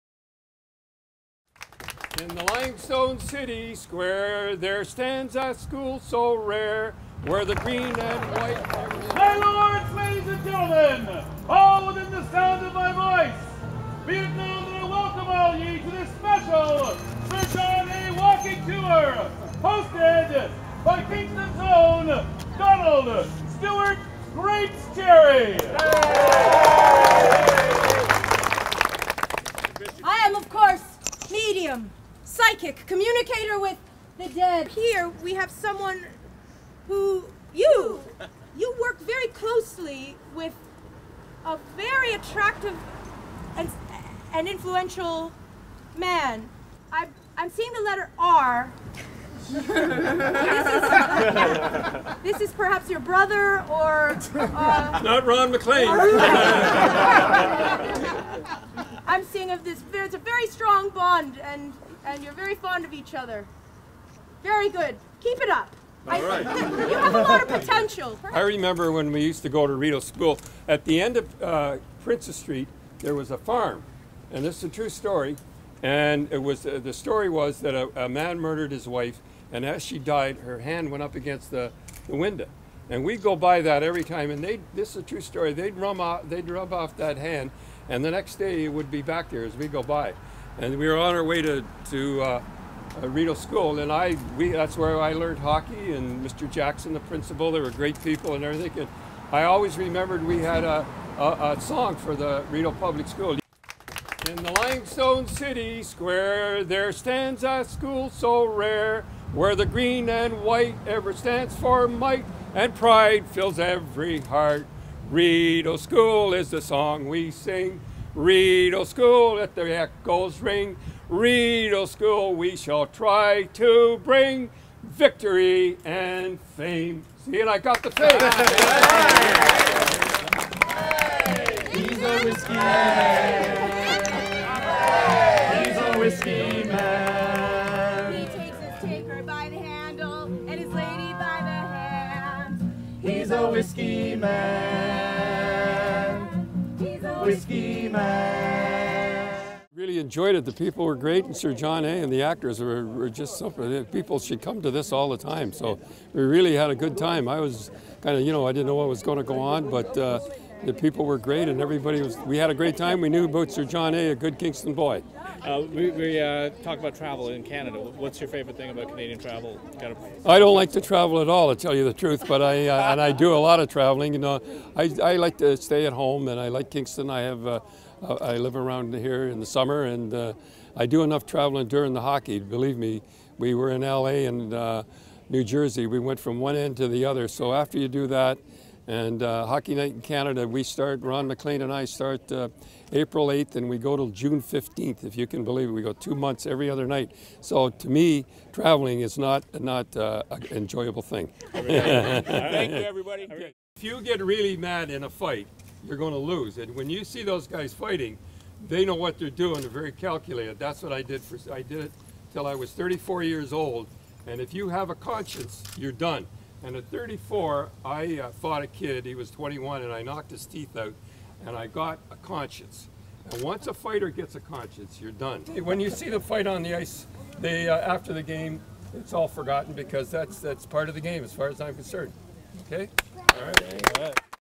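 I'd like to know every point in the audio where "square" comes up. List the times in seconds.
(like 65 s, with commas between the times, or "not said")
3 s, 105 s.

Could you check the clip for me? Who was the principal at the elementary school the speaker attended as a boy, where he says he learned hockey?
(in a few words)
Mr. Jackson.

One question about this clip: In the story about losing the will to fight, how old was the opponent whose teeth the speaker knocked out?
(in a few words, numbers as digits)
21.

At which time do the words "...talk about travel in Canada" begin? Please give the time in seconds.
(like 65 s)
166 s.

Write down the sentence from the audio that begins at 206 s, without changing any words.
And when you see those guys fighting, they know what they're doing.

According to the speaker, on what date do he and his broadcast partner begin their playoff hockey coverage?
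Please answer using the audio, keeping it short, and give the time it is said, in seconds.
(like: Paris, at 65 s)
April 8, at 192 s.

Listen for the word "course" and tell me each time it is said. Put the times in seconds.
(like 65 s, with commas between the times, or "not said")
30 s.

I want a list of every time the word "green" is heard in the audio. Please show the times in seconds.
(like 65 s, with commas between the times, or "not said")
7 s, 109 s.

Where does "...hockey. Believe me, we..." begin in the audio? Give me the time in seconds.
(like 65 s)
182 s.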